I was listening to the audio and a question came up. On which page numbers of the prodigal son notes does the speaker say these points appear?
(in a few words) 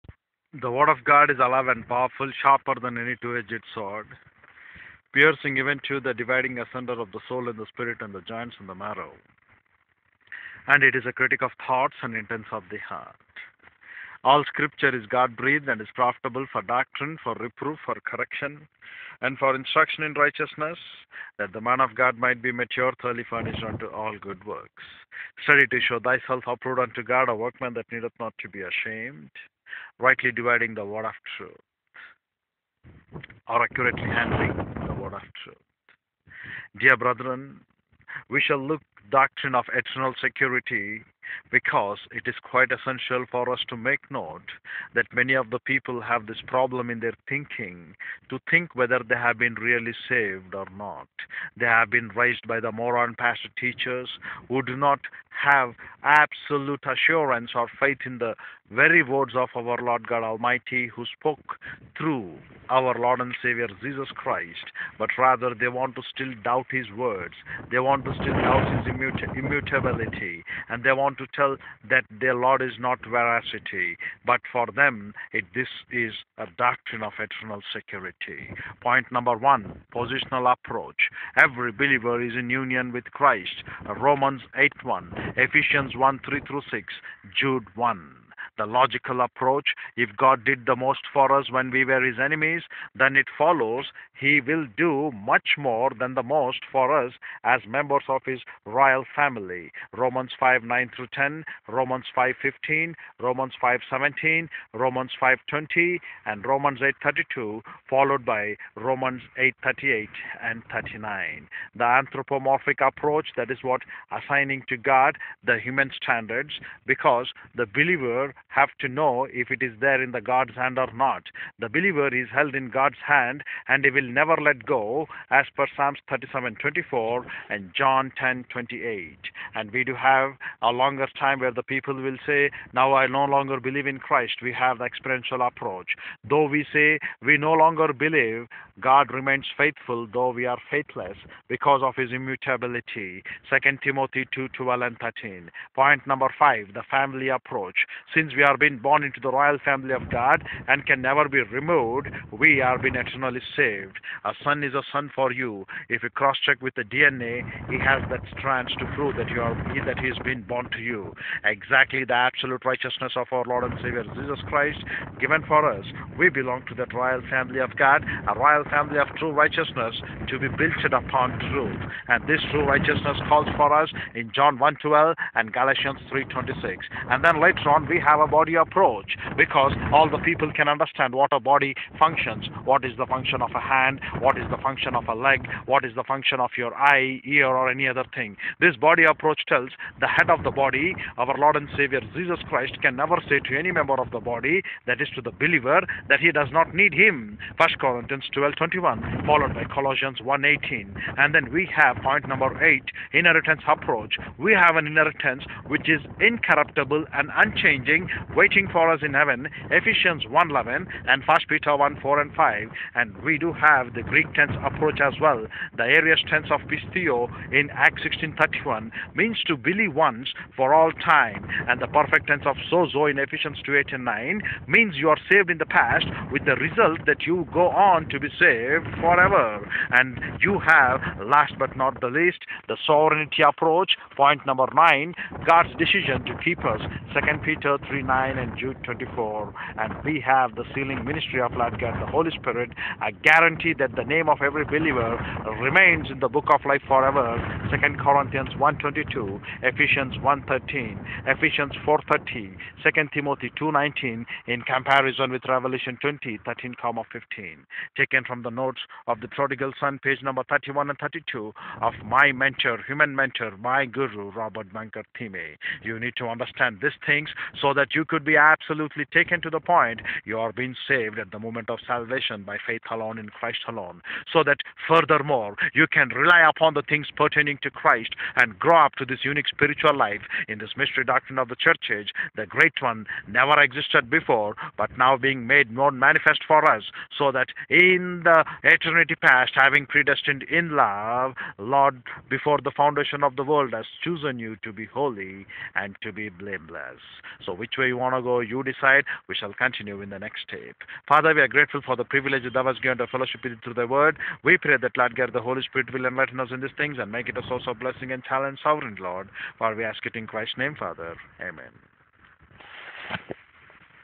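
31 and 32.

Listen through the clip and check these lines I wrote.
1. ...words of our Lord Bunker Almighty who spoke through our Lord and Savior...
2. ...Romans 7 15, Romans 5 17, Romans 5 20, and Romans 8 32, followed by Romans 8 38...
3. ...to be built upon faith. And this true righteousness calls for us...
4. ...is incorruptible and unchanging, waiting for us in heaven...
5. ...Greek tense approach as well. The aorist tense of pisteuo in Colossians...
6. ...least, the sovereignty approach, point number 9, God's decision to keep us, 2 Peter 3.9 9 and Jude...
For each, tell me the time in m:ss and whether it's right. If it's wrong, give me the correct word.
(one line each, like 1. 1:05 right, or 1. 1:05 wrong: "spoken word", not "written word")
1. 0:59 wrong: "God", not "Bunker"
2. 1:41 wrong: "5", not "7"
3. 2:50 wrong: "truth", not "faith"
4. 3:25 right
5. 3:34 wrong: "Acts", not "Colossians"
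6. 3:52 right.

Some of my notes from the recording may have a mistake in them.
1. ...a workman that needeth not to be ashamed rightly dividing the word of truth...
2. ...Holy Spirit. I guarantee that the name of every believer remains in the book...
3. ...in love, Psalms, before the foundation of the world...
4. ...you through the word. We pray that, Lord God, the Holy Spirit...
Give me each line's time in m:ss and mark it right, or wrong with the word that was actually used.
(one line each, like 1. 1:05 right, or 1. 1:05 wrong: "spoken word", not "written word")
1. 0:27 right
2. 4:02 right
3. 4:50 wrong: "Lord", not "Psalms"
4. 5:03 right.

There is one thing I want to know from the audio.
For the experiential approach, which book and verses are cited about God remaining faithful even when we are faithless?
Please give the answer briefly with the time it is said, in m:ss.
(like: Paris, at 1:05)
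2 Timothy 2:12-13, at 2:23.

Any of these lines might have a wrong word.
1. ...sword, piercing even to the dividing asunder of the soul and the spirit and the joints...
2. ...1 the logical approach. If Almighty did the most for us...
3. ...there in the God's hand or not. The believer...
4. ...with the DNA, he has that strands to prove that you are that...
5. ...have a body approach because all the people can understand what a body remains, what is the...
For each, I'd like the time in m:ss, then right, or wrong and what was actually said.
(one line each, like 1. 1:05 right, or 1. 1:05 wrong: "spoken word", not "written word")
1. 0:03 right
2. 1:27 wrong: "God", not "Almighty"
3. 1:59 right
4. 2:36 right
5. 2:57 wrong: "functions", not "remains".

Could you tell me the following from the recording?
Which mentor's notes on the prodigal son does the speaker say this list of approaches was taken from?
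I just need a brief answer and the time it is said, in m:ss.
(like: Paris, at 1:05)
Robert Bunker Thieme, at 4:24.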